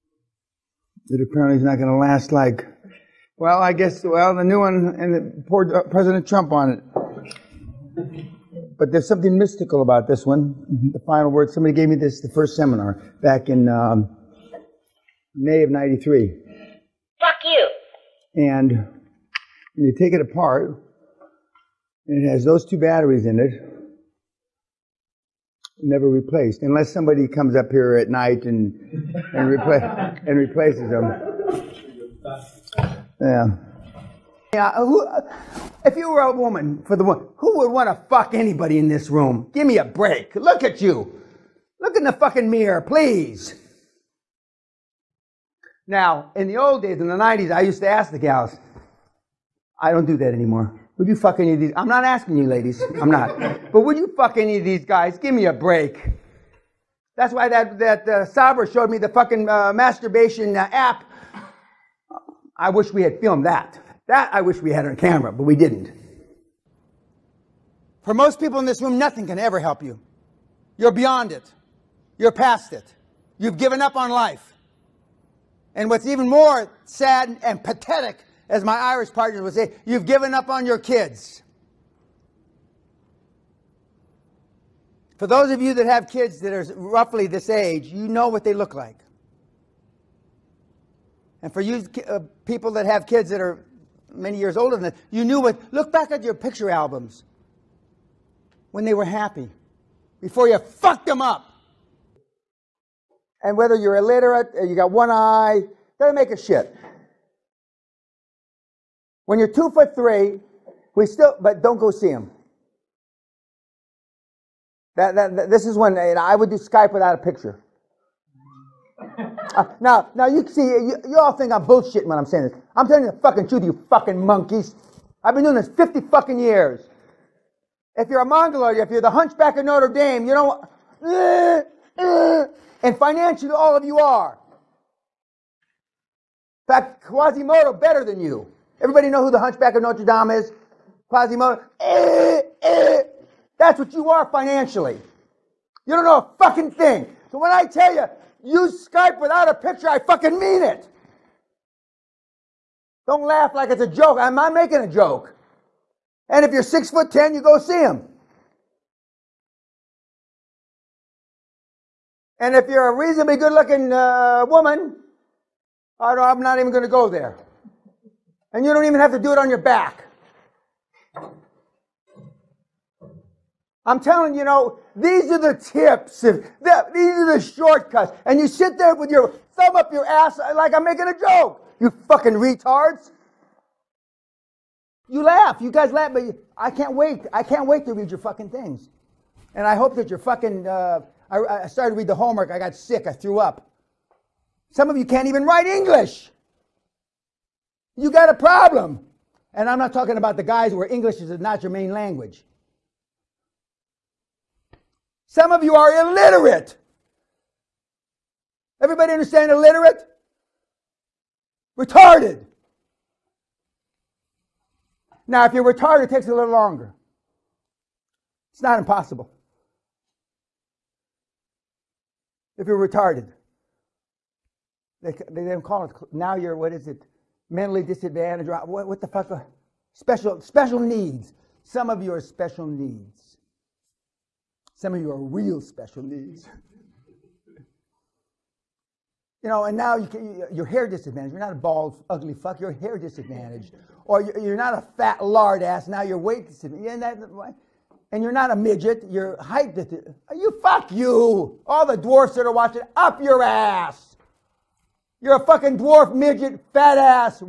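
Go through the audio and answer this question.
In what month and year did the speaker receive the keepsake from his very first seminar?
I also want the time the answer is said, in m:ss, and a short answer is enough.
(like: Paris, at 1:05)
May 1993, at 0:15.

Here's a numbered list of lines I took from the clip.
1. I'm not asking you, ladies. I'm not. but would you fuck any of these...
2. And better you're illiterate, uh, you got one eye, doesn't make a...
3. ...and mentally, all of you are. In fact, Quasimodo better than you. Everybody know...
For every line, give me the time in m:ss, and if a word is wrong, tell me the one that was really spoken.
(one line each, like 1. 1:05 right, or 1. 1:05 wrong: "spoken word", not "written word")
1. 0:51 right
2. 1:43 wrong: "whether", not "better"
3. 2:12 wrong: "financially", not "mentally".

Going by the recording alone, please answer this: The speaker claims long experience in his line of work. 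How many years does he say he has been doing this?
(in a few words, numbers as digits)
50.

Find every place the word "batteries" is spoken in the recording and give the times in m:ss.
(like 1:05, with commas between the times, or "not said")
0:22.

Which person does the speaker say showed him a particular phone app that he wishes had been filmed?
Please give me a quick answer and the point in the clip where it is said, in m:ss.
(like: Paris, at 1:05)
Sabra, at 0:58.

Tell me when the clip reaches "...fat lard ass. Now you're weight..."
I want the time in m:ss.
4:04.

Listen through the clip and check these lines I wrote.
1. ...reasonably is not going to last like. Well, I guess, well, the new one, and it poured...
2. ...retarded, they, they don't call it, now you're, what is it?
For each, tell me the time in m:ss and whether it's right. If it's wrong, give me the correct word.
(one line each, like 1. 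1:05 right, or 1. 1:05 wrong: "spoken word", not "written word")
1. 0:01 wrong: "apparently", not "reasonably"
2. 3:42 right.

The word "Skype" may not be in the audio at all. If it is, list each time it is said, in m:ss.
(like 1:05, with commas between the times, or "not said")
1:56, 2:28.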